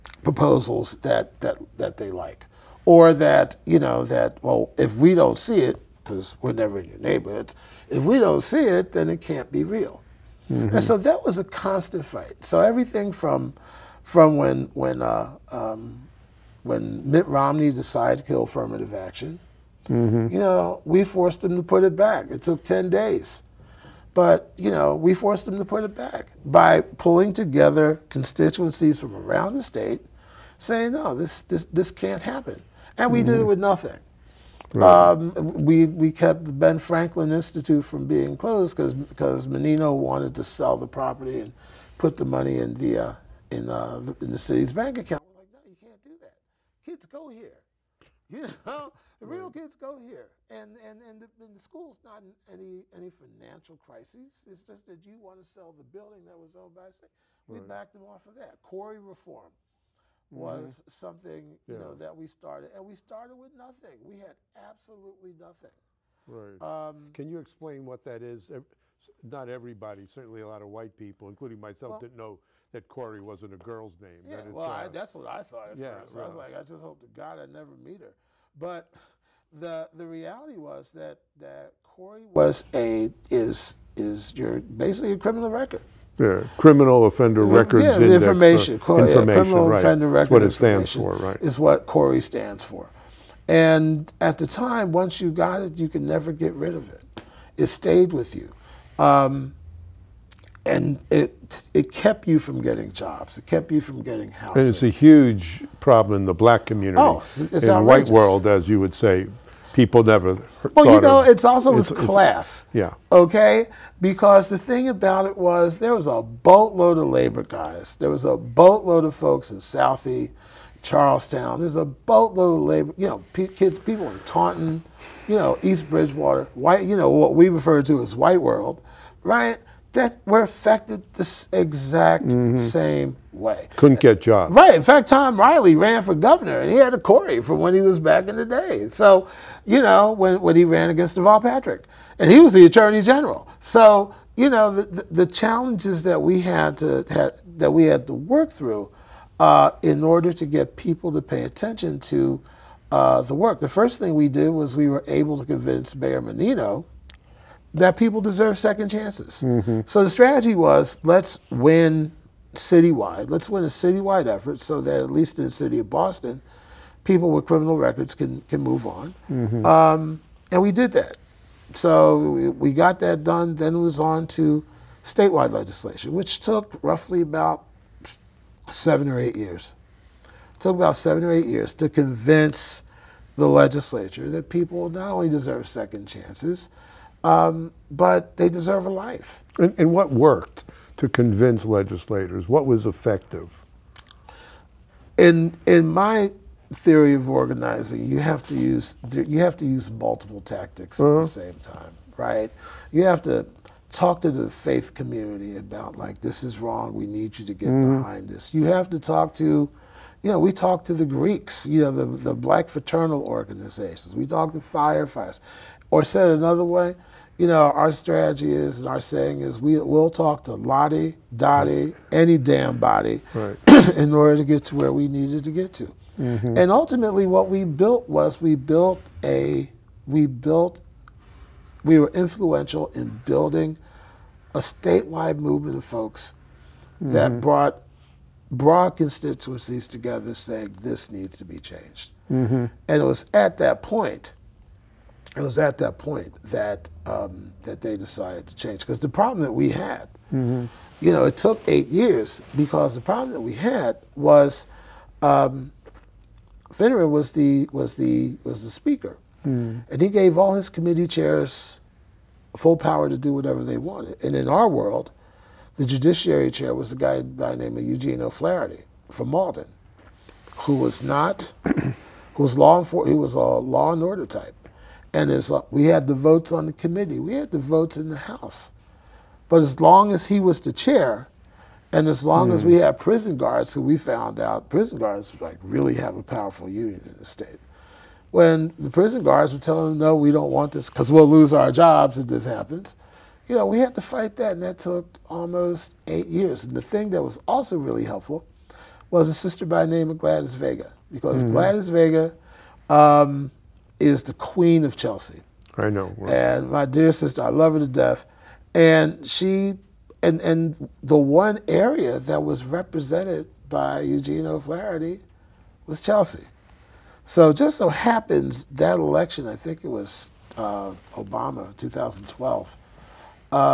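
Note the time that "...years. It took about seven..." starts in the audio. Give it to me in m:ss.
2:59.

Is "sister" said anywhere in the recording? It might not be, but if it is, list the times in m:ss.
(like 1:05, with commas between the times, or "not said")
4:59, 5:07.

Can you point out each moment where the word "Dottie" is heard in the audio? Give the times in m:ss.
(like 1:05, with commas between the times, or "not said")
3:41.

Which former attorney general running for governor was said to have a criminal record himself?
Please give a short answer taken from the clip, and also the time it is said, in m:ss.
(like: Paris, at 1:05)
Tom Reilly, at 2:15.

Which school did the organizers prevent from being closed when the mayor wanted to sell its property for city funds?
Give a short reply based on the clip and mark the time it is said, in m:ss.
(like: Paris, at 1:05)
Ben Franklin Institute, at 0:36.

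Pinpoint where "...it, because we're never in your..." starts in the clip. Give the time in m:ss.
0:05.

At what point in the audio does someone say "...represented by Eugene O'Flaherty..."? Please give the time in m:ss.
5:12.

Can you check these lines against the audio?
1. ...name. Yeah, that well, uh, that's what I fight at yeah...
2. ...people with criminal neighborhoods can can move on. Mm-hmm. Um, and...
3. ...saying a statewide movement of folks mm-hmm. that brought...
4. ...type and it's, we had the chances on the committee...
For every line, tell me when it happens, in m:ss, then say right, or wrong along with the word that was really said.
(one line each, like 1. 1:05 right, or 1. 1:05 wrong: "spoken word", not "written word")
1. 1:13 wrong: "thought", not "fight"
2. 2:47 wrong: "records", not "neighborhoods"
3. 3:53 wrong: "building", not "saying"
4. 4:34 wrong: "votes", not "chances".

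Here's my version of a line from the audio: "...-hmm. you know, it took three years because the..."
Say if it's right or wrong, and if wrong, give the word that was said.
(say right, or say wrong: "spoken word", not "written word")
wrong: "eight", not "three".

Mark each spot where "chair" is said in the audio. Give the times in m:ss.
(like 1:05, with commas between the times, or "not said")
4:21, 4:26, 4:40.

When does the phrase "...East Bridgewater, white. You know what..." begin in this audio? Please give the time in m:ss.
2:05.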